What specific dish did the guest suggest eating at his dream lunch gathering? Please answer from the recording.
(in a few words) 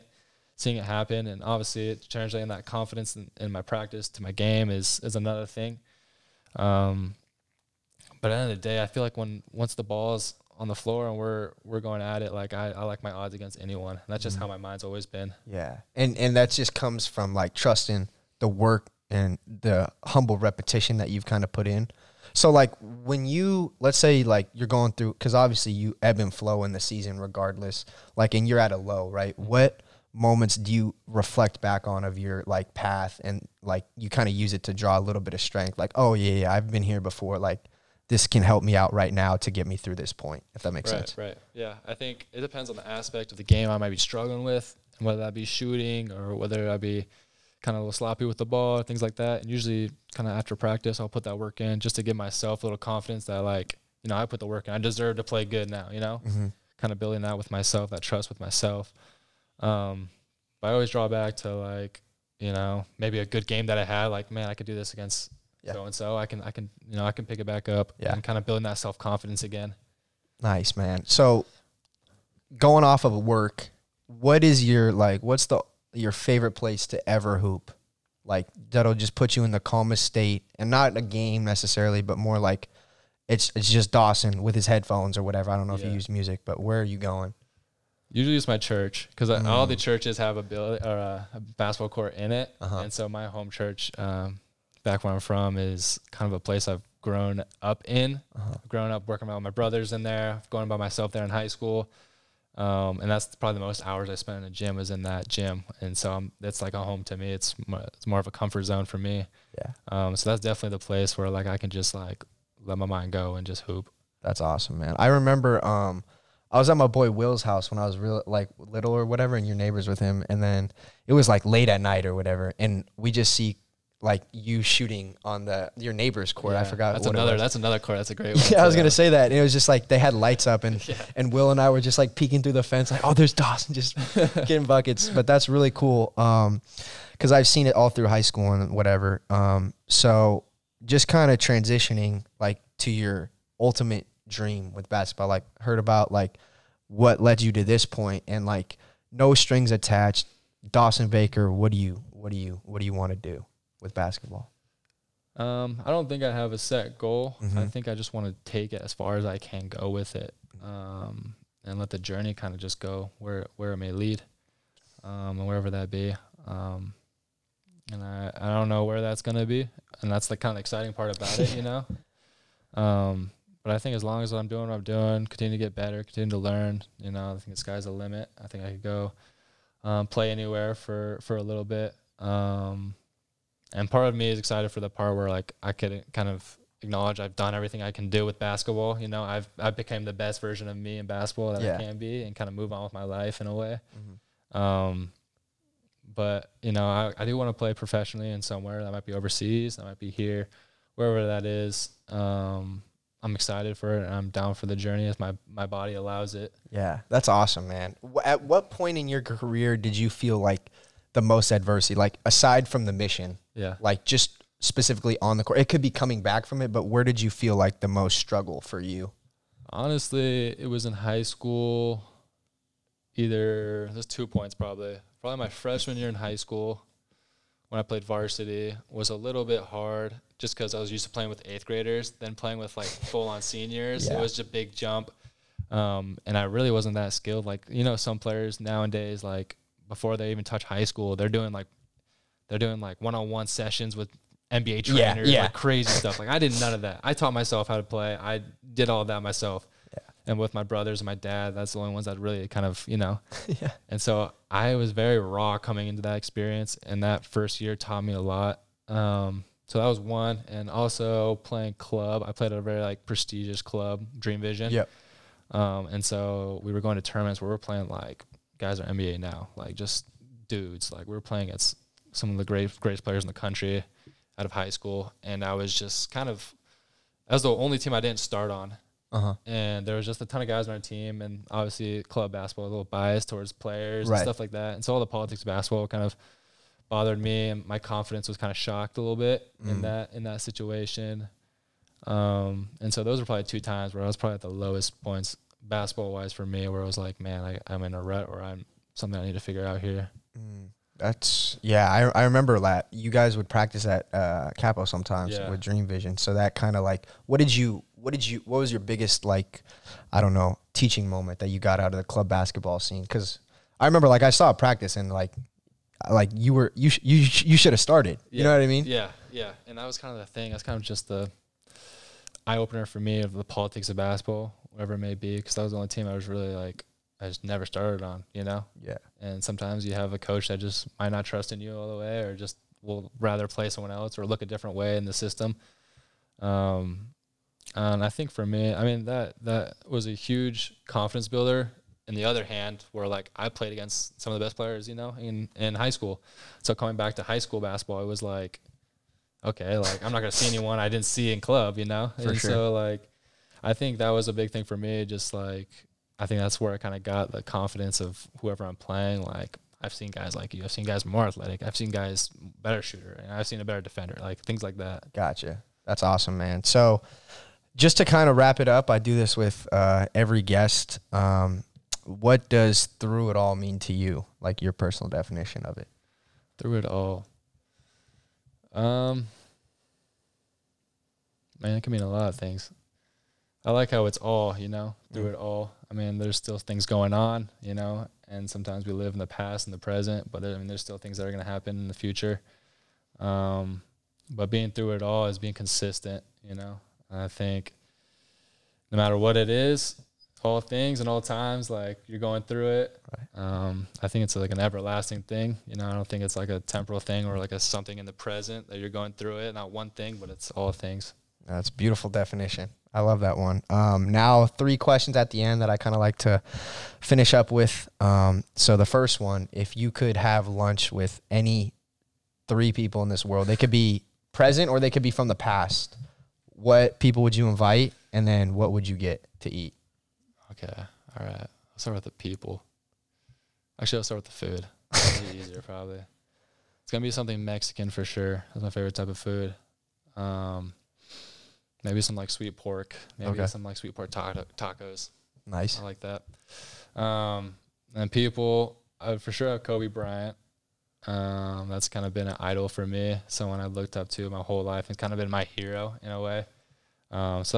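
Sweet pork tacos.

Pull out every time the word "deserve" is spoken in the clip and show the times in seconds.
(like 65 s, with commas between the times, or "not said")
54 s.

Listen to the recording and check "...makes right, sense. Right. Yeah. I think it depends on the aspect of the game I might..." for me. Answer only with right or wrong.
right.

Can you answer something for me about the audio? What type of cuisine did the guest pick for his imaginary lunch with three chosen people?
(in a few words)
Mexican.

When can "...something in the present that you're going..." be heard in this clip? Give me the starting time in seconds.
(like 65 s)
407 s.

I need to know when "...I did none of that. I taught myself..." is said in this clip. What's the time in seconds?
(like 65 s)
246 s.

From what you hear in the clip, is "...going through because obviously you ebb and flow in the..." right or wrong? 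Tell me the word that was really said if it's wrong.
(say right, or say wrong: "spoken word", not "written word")
right.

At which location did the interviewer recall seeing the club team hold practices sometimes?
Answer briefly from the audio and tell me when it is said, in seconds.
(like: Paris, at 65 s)
Capo, at 304 s.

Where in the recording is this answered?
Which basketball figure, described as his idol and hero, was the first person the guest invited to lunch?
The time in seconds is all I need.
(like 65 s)
449 s.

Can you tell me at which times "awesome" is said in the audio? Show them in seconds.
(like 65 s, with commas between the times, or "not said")
114 s, 207 s, 366 s.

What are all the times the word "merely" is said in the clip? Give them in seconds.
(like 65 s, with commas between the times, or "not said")
not said.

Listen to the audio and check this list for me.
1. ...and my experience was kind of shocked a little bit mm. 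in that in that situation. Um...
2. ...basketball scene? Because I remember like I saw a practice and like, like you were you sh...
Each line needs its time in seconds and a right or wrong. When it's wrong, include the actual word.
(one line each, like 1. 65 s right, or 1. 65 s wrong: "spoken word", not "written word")
1. 287 s wrong: "confidence", not "experience"
2. 312 s right.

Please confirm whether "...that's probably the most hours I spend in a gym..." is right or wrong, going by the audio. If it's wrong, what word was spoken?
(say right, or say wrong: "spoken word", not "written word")
right.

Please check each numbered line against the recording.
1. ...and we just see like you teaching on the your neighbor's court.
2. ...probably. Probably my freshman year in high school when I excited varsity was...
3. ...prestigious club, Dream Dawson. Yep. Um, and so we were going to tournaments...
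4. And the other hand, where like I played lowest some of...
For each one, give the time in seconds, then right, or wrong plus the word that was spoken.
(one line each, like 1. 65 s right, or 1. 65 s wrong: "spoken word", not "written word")
1. 122 s wrong: "shooting", not "teaching"
2. 224 s wrong: "played", not "excited"
3. 263 s wrong: "Vision", not "Dawson"
4. 342 s wrong: "against", not "lowest".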